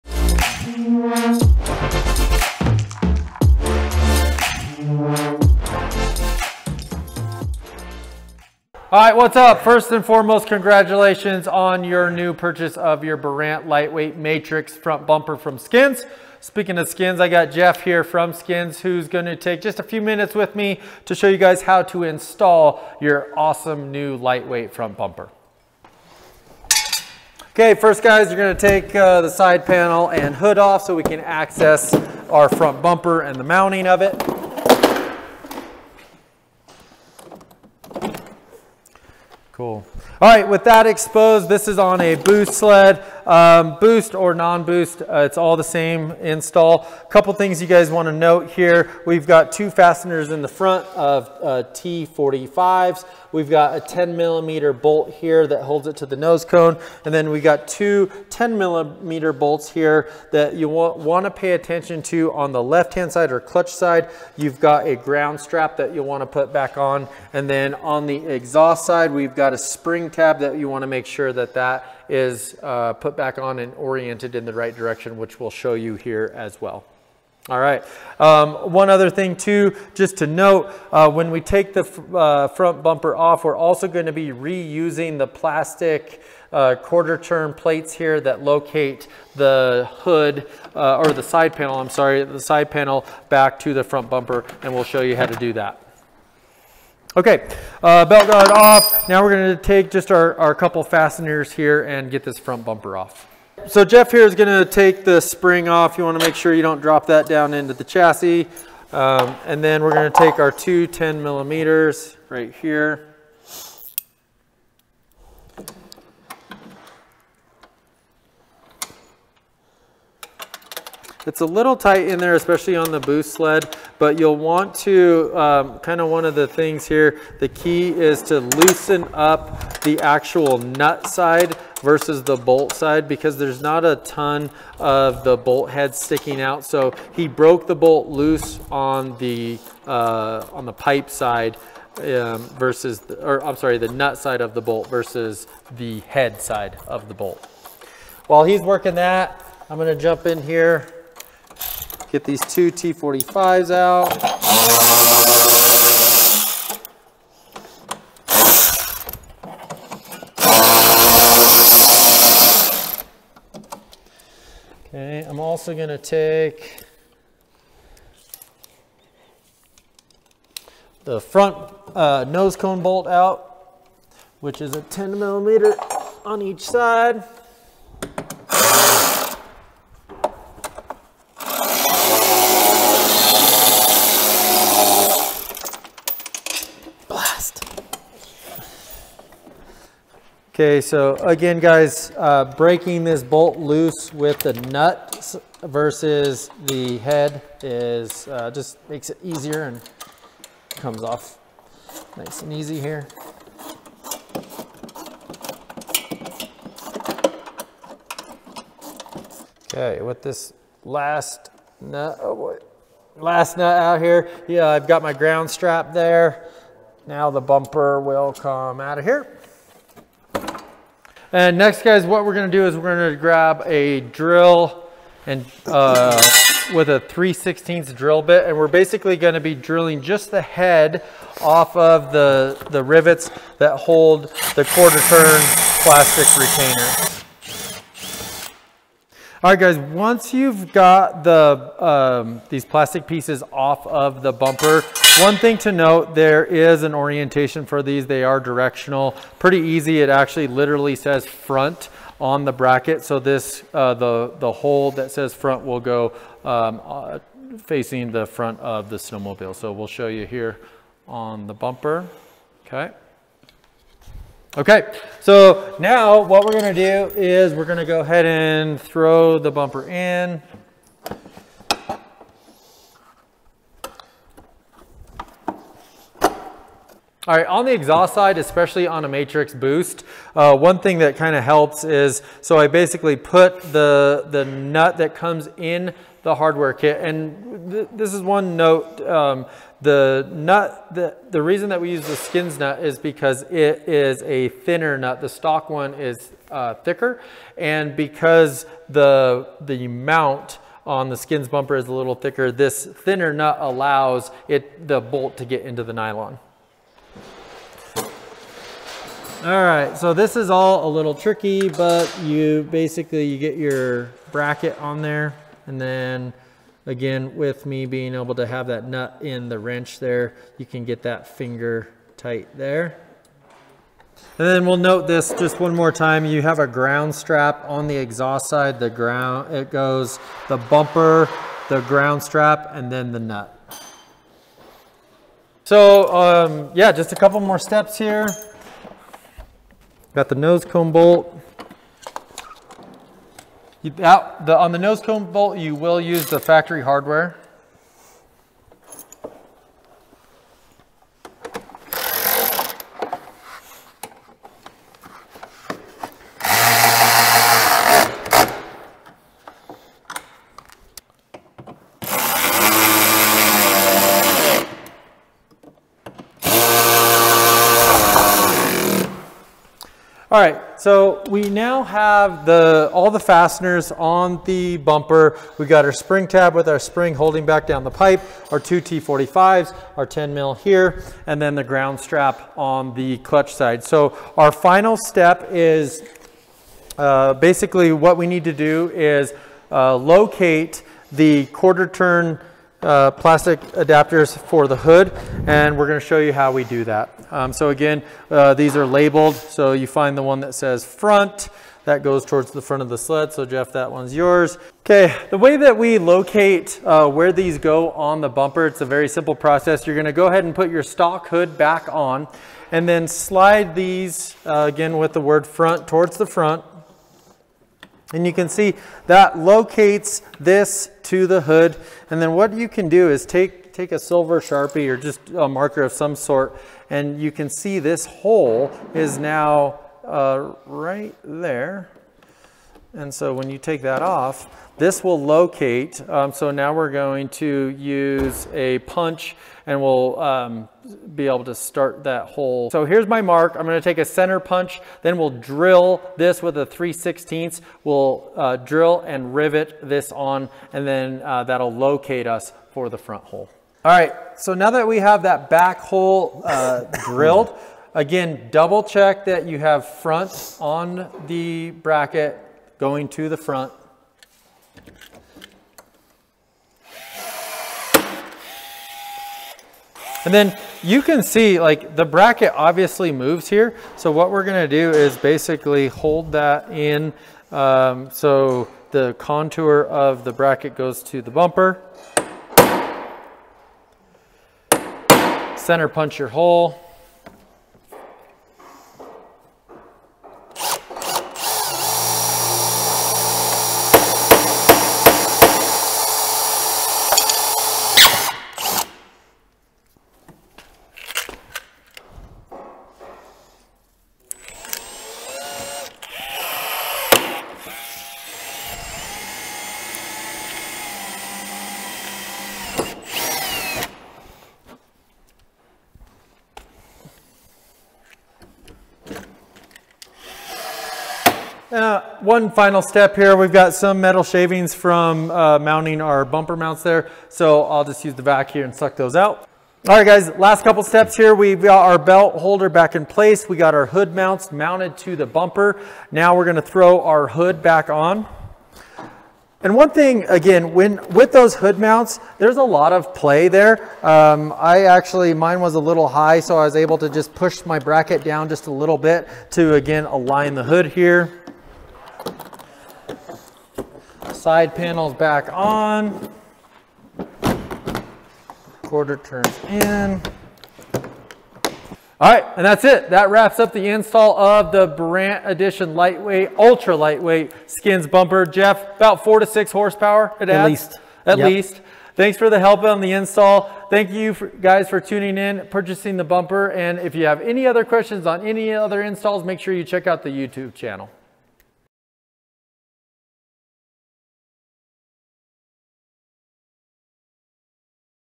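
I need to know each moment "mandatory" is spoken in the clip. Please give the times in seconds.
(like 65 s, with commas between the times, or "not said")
not said.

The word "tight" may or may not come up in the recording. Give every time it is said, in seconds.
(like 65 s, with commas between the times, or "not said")
121 s, 322 s.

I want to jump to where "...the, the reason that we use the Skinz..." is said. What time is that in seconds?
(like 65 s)
290 s.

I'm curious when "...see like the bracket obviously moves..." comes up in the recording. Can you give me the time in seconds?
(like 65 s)
471 s.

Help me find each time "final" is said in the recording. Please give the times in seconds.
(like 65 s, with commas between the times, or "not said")
384 s, 522 s.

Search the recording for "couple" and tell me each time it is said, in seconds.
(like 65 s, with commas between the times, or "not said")
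47 s, 100 s, 337 s, 530 s.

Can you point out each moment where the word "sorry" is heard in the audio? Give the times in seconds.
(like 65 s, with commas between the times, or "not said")
91 s, 143 s.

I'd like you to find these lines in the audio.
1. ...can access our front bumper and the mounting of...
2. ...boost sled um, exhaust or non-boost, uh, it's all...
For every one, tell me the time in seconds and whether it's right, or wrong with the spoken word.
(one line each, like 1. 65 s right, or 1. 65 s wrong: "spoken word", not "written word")
1. 31 s right
2. 42 s wrong: "boost", not "exhaust".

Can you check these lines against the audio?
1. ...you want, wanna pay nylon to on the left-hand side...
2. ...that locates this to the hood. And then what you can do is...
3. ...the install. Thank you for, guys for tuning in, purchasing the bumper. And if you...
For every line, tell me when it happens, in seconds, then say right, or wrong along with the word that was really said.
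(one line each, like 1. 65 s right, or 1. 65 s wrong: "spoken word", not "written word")
1. 60 s wrong: "attention", not "nylon"
2. 419 s right
3. 572 s right.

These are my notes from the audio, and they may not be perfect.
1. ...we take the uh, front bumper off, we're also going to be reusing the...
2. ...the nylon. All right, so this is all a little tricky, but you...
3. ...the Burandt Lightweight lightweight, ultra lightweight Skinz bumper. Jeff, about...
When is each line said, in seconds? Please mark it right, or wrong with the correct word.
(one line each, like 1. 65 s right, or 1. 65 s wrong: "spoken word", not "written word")
1. 81 s right
2. 305 s right
3. 564 s wrong: "Edition", not "Lightweight".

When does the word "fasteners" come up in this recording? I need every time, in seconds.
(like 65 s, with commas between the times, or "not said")
49 s, 100 s, 373 s.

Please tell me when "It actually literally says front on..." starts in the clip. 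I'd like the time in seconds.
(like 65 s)
250 s.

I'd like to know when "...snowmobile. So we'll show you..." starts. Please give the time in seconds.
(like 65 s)
258 s.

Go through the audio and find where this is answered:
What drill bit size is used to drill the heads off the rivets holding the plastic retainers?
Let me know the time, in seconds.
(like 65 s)
226 s.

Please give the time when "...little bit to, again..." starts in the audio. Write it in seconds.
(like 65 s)
548 s.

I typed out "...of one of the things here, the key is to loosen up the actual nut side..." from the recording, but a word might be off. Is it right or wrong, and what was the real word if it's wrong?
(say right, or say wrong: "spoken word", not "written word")
right.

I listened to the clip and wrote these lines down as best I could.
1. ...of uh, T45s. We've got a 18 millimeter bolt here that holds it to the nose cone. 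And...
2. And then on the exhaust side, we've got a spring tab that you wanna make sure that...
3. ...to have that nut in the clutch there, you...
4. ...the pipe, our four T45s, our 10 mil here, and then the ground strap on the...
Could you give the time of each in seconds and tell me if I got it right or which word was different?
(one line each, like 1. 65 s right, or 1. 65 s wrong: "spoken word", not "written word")
1. 50 s wrong: "10", not "18"
2. 67 s right
3. 318 s wrong: "wrench", not "clutch"
4. 377 s wrong: "two", not "four".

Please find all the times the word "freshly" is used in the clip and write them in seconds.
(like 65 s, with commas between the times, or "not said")
not said.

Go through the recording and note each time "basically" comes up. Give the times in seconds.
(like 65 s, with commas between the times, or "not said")
228 s, 282 s, 312 s, 387 s, 475 s.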